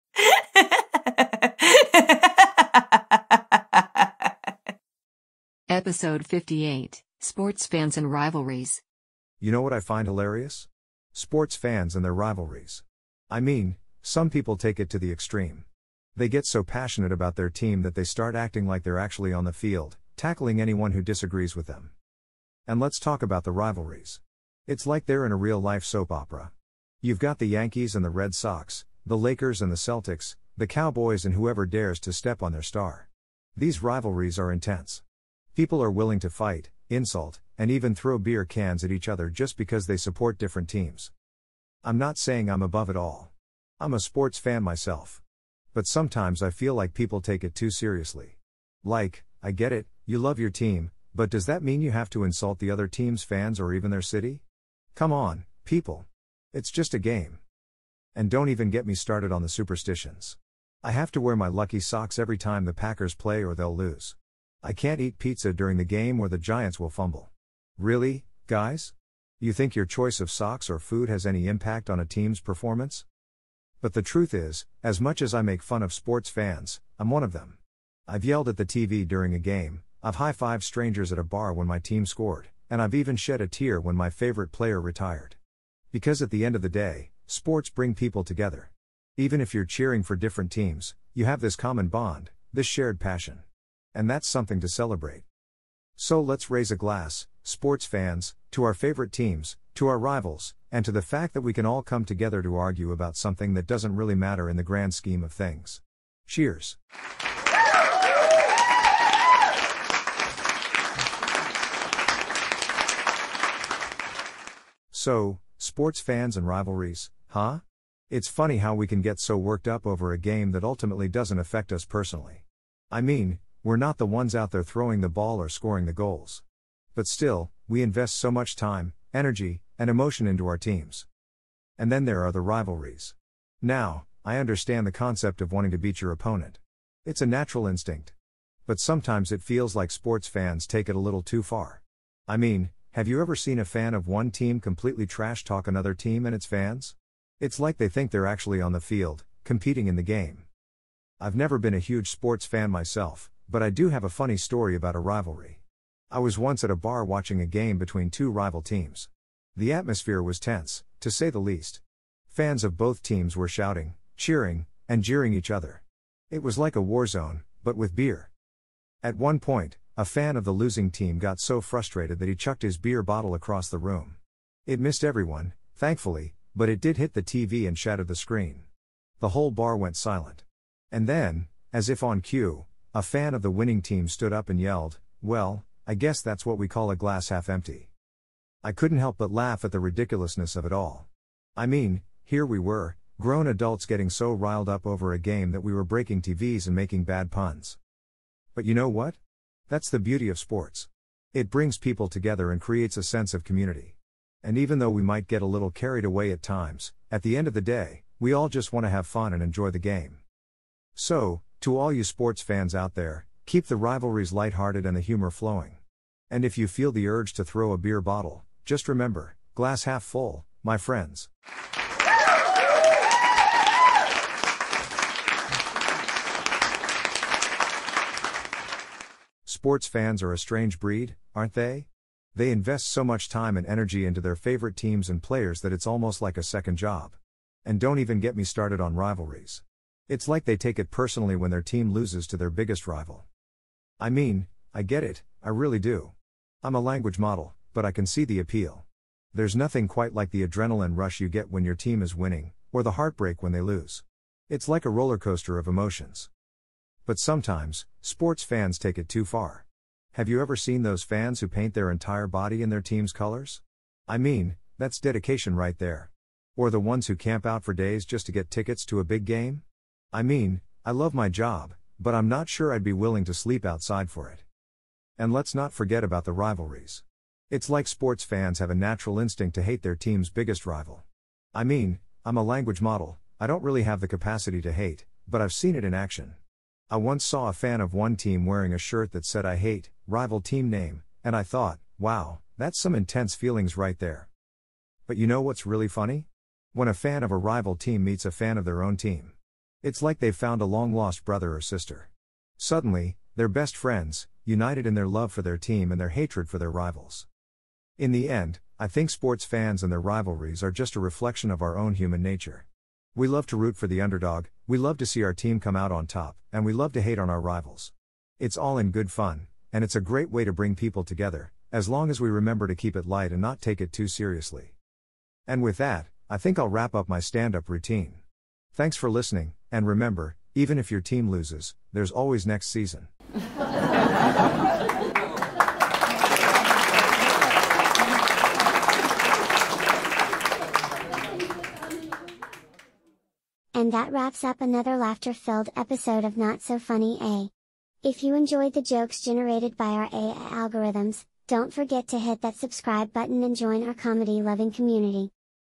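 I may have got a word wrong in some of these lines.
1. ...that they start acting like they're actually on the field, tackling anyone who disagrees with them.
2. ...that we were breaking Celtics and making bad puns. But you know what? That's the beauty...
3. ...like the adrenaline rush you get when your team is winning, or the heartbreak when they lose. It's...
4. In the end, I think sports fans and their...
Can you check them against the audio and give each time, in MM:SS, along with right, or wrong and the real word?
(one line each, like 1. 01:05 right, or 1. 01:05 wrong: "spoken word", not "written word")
1. 00:17 right
2. 03:15 wrong: "TVs", not "Celtics"
3. 04:10 right
4. 05:07 right.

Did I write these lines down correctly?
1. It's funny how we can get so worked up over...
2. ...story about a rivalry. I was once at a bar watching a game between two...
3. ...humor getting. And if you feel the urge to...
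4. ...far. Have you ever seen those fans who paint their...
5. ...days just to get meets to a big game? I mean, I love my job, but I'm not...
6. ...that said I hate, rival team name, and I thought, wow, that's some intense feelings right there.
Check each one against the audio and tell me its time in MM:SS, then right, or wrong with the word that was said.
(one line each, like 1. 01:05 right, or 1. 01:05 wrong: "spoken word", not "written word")
1. 01:58 right
2. 02:34 right
3. 03:35 wrong: "flowing", not "getting"
4. 04:19 right
5. 04:27 wrong: "tickets", not "meets"
6. 04:49 right.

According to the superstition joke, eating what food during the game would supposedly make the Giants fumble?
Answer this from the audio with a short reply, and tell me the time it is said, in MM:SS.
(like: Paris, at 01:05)
Pizza, at 01:05.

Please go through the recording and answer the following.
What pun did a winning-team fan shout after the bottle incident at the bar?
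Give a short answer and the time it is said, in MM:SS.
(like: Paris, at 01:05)
A glass half empty, at 03:06.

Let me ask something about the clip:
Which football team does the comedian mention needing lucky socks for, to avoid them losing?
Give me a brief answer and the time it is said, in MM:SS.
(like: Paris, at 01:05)
Packers, at 01:02.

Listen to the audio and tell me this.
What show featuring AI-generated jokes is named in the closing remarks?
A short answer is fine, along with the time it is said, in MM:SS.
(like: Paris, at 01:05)
Not So Funny A, at 05:46.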